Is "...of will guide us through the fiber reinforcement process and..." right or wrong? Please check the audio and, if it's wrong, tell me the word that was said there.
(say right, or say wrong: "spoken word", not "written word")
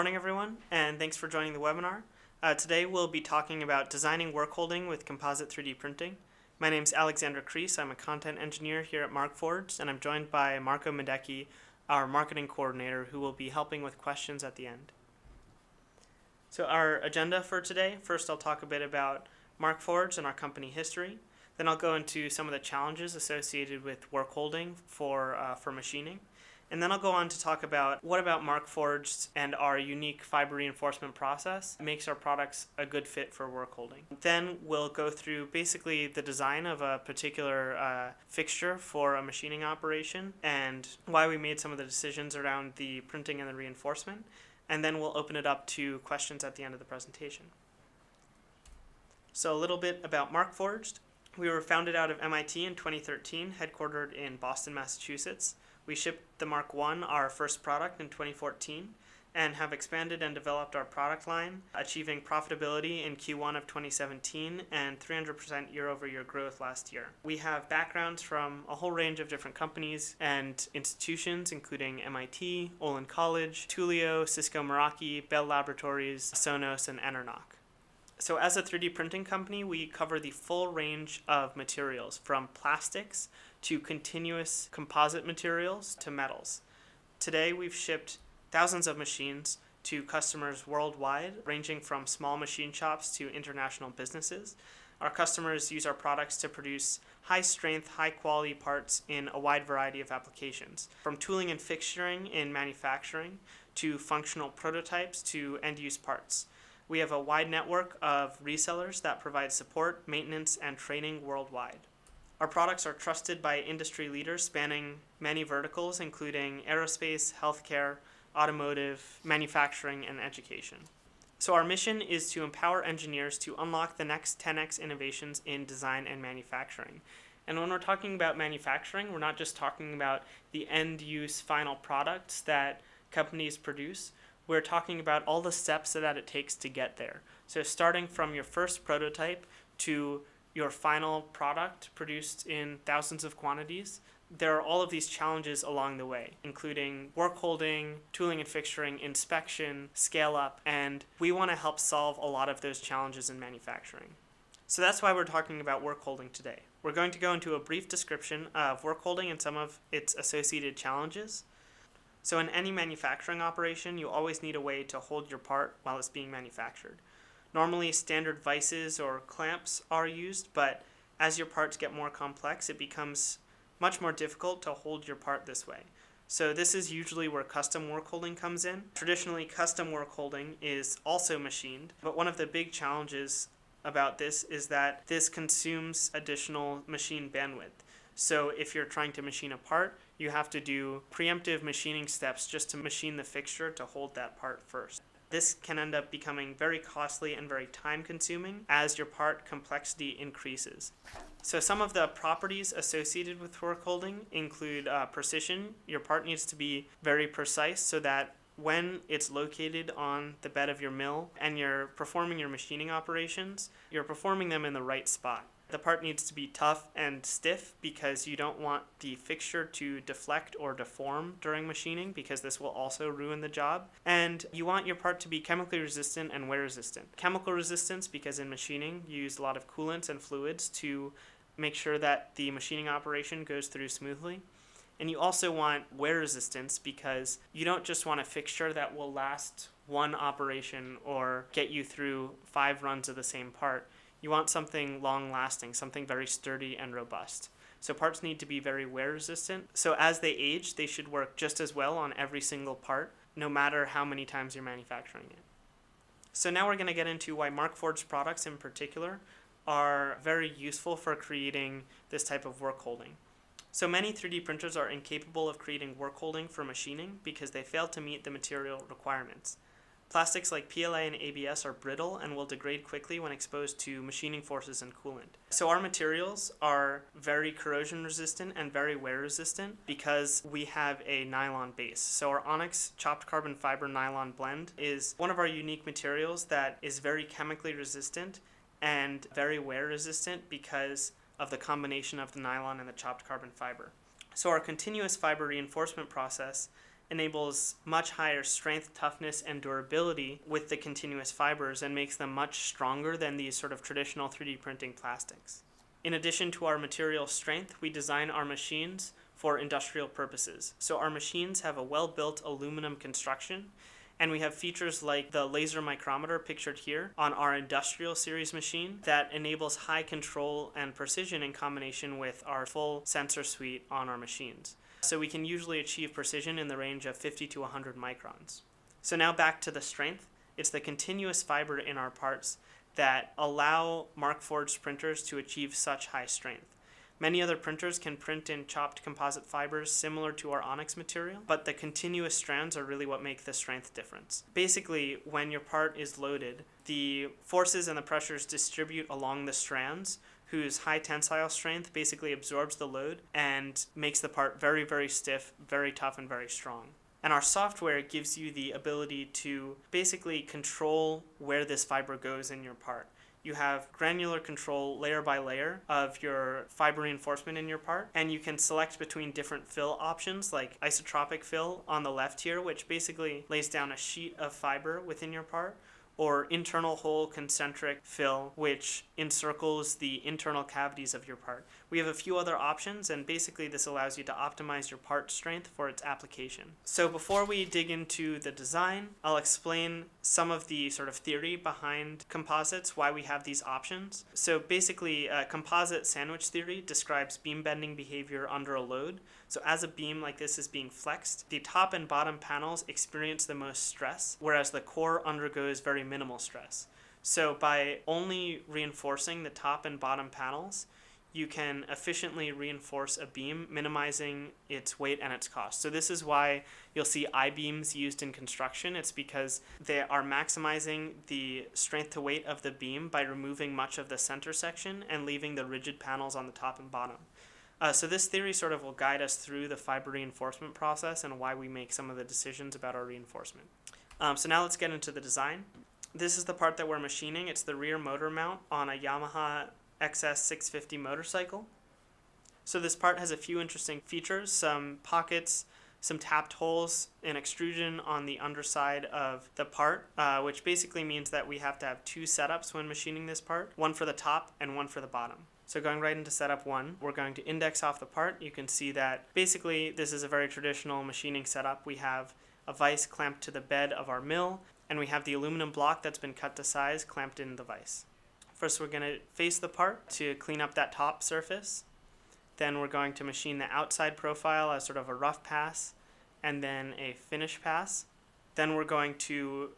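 right.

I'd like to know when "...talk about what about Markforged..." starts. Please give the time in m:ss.
0:27.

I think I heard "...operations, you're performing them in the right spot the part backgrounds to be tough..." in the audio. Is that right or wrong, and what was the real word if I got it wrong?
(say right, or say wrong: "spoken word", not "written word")
wrong: "needs", not "backgrounds".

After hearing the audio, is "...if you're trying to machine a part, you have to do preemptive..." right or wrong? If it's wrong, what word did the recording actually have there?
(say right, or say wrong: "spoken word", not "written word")
right.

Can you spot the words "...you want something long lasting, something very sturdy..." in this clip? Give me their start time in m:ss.
4:04.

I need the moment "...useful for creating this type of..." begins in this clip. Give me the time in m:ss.
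4:20.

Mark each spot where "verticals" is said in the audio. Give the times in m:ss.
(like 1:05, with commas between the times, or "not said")
1:55.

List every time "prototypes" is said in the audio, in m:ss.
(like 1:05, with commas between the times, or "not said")
1:44, 2:18.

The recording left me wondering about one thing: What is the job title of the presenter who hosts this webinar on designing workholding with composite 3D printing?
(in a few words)
Content engineer.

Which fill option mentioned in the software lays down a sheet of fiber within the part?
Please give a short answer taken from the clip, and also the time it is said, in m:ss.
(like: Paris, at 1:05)
Isotropic fill, at 6:10.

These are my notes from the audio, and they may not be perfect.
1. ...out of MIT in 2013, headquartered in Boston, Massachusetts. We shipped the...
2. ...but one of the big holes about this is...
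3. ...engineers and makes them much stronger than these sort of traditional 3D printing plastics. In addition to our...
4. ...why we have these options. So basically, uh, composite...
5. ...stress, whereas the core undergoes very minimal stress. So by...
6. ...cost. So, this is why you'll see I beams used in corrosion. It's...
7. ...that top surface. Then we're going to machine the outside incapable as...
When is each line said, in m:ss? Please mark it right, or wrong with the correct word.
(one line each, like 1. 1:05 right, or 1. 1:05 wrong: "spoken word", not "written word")
1. 0:51 right
2. 3:02 wrong: "challenges", not "holes"
3. 5:01 wrong: "fibers", not "engineers"
4. 6:32 right
5. 6:43 right
6. 6:55 wrong: "construction", not "corrosion"
7. 7:50 wrong: "profile", not "incapable".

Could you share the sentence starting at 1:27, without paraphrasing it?
Today we've shipped thousands of machines to customers worldwide, ranging from small machine shops to international businesses.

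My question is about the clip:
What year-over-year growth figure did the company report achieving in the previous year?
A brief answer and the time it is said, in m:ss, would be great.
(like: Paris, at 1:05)
300%, at 1:04.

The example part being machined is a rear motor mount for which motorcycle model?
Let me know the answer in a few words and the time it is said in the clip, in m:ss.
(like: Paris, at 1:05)
Yamaha XS650, at 7:18.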